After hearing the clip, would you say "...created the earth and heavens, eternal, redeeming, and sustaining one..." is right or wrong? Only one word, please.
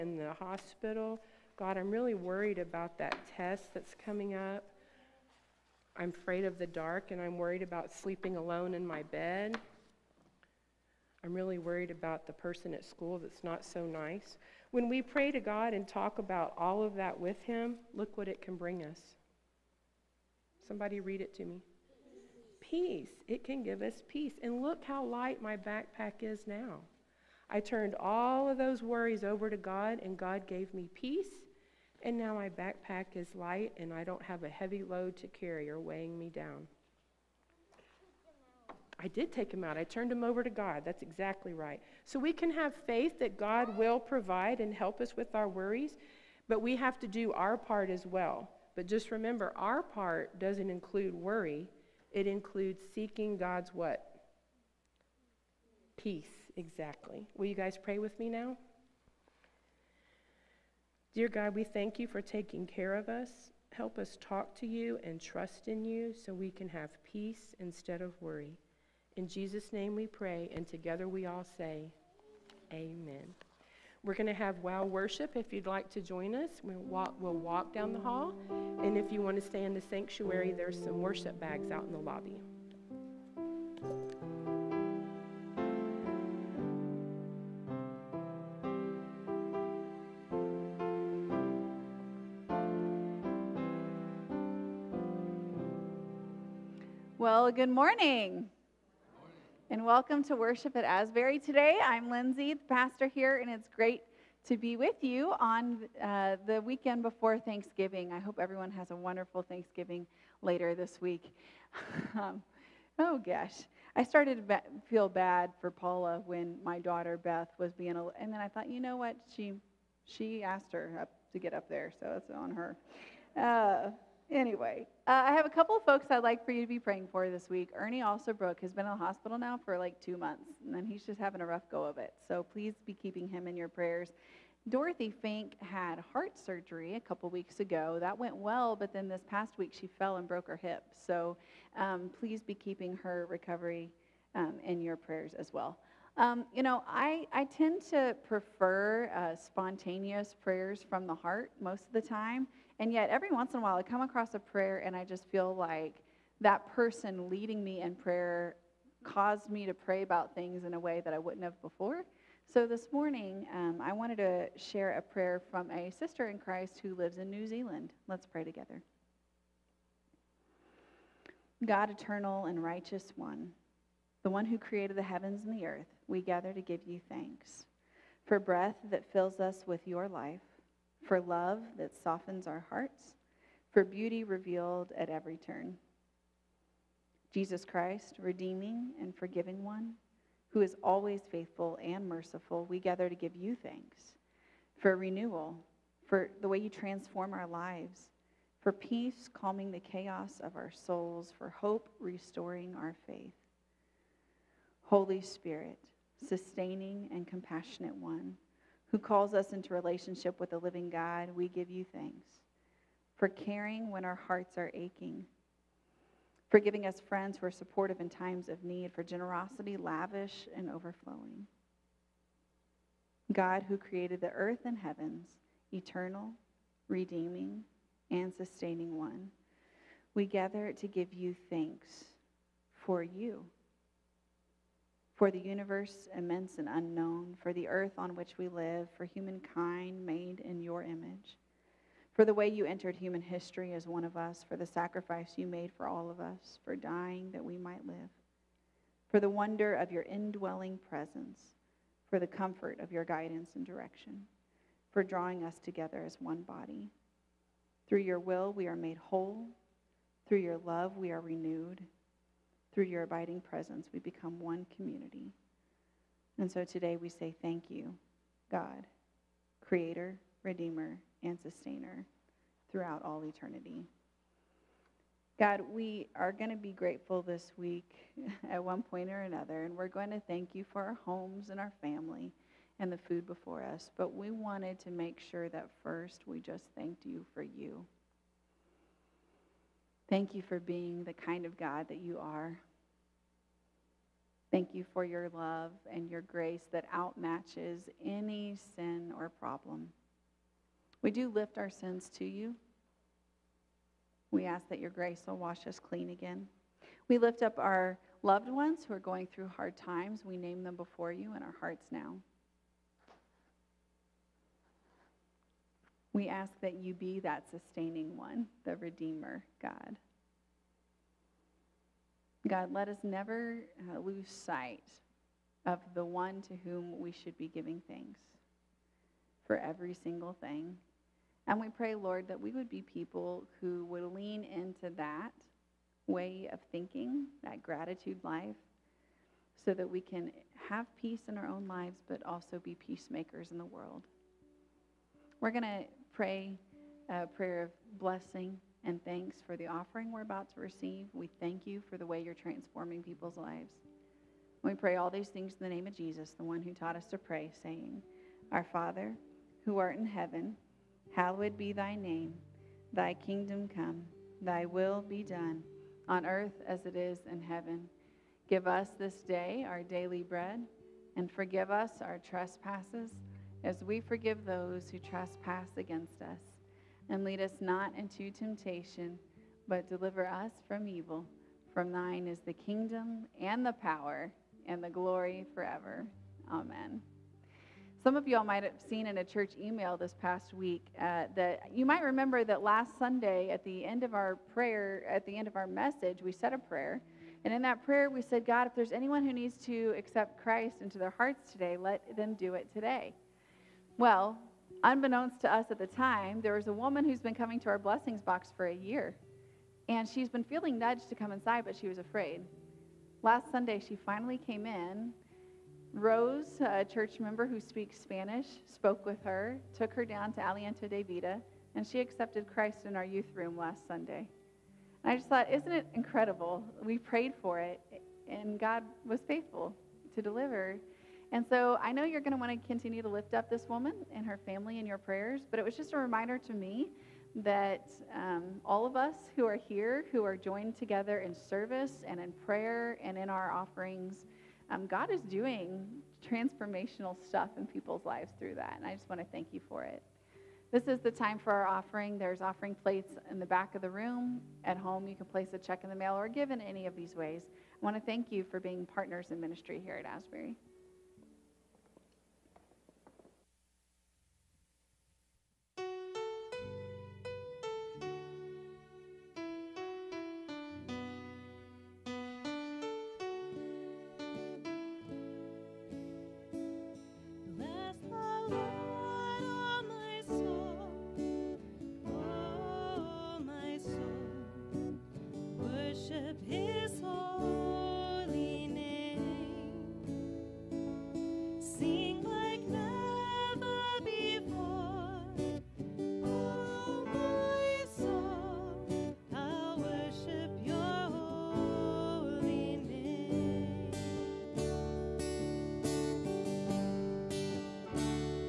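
right.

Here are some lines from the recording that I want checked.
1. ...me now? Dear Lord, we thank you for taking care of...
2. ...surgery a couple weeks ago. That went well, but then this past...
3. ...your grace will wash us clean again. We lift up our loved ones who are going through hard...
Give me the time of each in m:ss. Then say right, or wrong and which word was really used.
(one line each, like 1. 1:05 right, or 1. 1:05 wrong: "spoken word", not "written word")
1. 0:58 wrong: "God", not "Lord"
2. 2:16 right
3. 5:04 right.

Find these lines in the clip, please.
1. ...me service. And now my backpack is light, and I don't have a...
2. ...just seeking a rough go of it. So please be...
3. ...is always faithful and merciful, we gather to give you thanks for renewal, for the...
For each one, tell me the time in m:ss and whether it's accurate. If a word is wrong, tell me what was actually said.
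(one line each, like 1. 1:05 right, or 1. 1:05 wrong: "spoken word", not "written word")
1. 0:30 wrong: "peace", not "service"
2. 2:11 wrong: "having", not "seeking"
3. 3:10 right.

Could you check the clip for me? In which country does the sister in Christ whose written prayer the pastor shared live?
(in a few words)
New Zealand.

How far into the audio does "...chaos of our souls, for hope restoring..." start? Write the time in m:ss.
3:19.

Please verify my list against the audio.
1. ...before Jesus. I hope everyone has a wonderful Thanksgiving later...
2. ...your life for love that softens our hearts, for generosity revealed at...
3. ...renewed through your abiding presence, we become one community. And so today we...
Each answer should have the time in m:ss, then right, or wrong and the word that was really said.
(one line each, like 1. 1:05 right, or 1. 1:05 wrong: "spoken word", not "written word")
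1. 1:47 wrong: "Thanksgiving", not "Jesus"
2. 2:59 wrong: "beauty", not "generosity"
3. 4:21 right.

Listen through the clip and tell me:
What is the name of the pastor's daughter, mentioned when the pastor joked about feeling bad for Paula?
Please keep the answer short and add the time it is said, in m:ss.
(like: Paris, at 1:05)
Beth, at 1:57.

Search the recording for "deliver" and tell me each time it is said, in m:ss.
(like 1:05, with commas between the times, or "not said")
6:19, 7:10.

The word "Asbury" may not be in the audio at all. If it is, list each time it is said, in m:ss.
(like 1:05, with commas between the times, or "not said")
1:40, 7:40.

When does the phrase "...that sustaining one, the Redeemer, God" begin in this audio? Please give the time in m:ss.
5:17.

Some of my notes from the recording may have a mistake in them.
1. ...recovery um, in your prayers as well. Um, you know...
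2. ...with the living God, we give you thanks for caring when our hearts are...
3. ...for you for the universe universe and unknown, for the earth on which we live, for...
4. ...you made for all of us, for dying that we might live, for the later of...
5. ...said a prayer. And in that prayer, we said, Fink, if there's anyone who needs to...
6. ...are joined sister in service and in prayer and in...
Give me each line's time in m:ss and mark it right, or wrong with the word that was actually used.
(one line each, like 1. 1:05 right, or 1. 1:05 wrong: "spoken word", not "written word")
1. 2:23 right
2. 3:30 right
3. 3:52 wrong: "immense", not "universe"
4. 4:05 wrong: "wonder", not "later"
5. 6:36 wrong: "God", not "Fink"
6. 7:20 wrong: "together", not "sister".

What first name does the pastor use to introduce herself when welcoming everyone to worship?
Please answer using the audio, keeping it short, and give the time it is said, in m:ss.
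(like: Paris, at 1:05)
Lindsay, at 1:42.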